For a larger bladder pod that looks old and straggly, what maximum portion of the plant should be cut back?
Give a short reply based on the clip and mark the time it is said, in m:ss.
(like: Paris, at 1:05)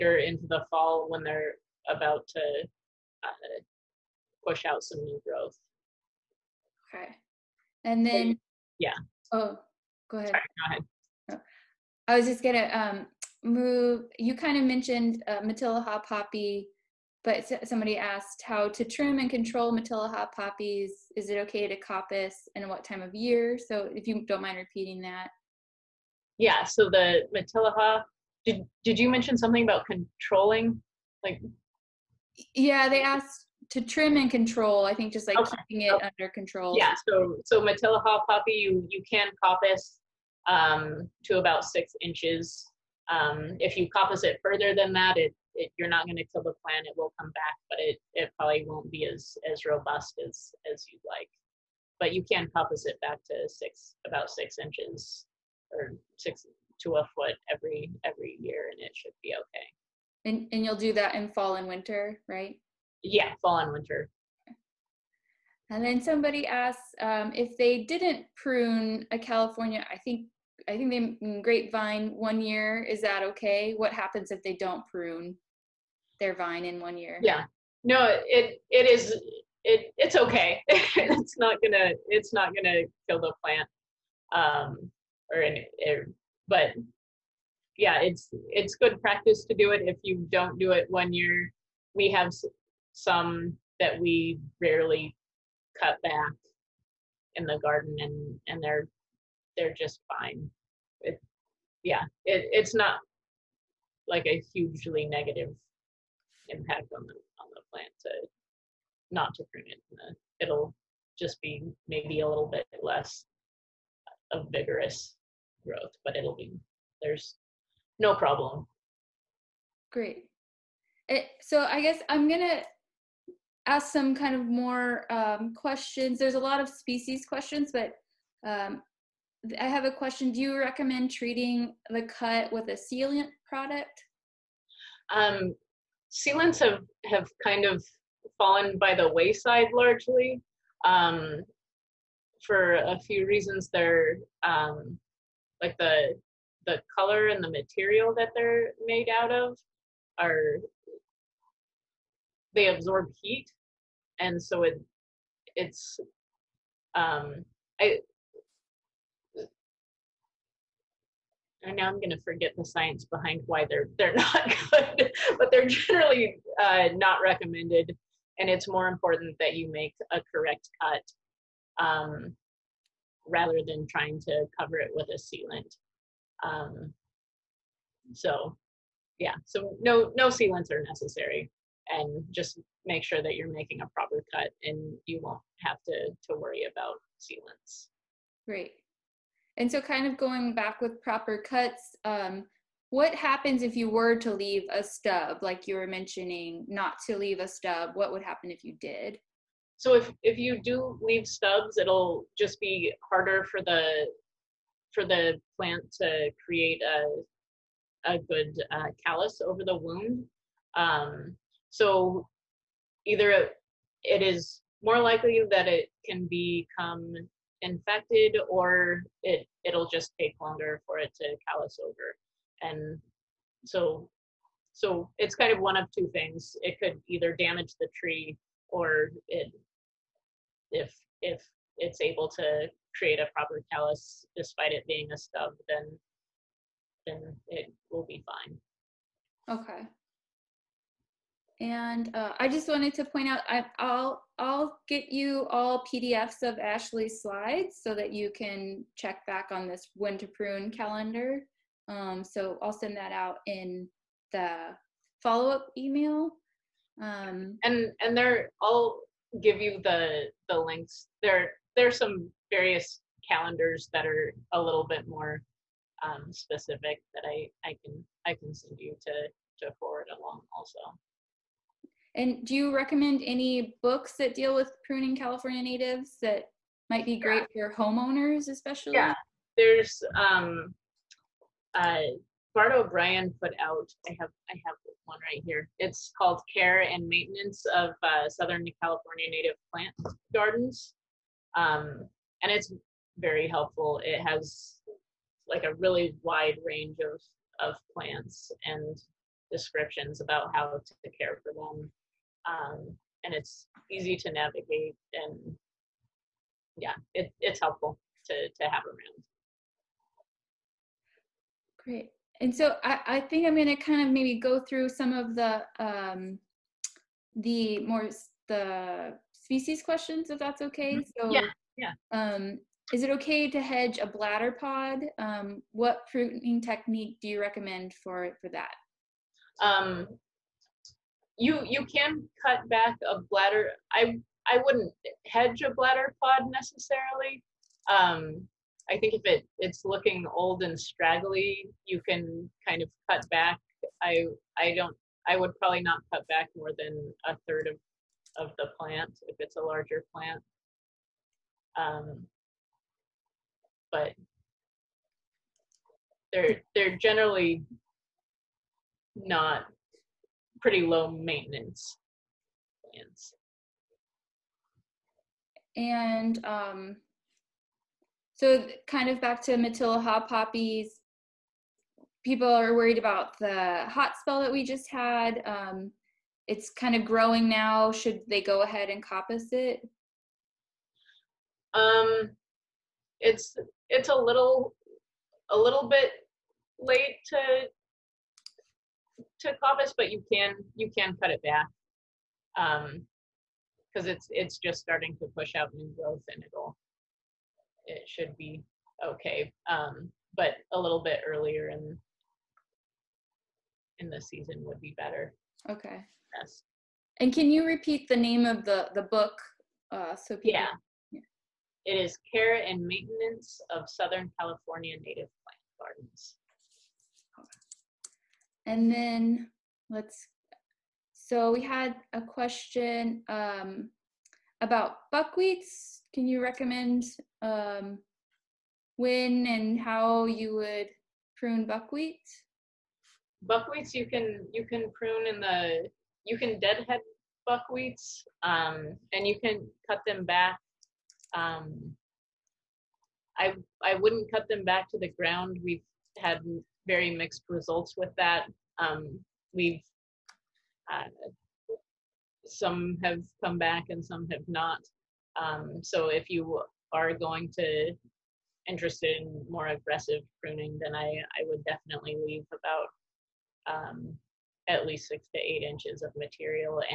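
a third, at 5:47.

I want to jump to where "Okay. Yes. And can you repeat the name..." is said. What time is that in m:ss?
6:45.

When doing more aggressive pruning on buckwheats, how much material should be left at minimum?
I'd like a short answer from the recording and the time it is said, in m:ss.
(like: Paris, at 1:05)
6 to 8 inches, at 7:45.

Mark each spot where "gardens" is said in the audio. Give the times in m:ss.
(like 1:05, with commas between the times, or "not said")
1:37, 4:50, 6:55.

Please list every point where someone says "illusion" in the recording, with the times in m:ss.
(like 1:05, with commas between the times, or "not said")
not said.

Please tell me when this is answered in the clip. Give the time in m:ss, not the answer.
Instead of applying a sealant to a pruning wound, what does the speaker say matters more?
2:50.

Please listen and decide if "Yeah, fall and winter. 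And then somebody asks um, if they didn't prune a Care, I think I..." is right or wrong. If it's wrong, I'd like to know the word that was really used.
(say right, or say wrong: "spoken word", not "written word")
wrong: "California", not "Care".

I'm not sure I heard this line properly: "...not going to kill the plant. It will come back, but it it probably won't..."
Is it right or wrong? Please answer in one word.
right.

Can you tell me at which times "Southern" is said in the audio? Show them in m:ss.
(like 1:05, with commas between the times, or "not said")
4:48, 6:53.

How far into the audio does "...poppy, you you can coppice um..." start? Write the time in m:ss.
0:38.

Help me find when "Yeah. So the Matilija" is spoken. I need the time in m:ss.
0:26.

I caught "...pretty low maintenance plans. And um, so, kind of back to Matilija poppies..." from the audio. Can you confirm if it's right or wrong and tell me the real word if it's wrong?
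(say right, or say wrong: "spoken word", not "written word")
right.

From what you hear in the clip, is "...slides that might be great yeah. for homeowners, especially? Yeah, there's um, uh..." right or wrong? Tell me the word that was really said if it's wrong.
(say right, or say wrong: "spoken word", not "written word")
wrong: "natives", not "slides".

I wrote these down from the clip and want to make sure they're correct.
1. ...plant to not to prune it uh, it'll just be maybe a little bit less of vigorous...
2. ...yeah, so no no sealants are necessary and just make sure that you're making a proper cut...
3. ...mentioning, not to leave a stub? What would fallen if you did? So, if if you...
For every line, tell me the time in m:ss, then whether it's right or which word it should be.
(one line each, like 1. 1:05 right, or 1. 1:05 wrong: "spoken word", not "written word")
1. 1:47 right
2. 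2:59 right
3. 3:15 wrong: "happen", not "fallen".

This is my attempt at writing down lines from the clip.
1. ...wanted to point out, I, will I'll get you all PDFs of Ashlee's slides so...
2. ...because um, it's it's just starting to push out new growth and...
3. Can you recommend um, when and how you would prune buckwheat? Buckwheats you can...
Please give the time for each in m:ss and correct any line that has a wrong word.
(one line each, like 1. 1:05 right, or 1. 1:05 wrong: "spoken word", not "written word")
1. 4:02 right
2. 6:32 right
3. 7:06 right.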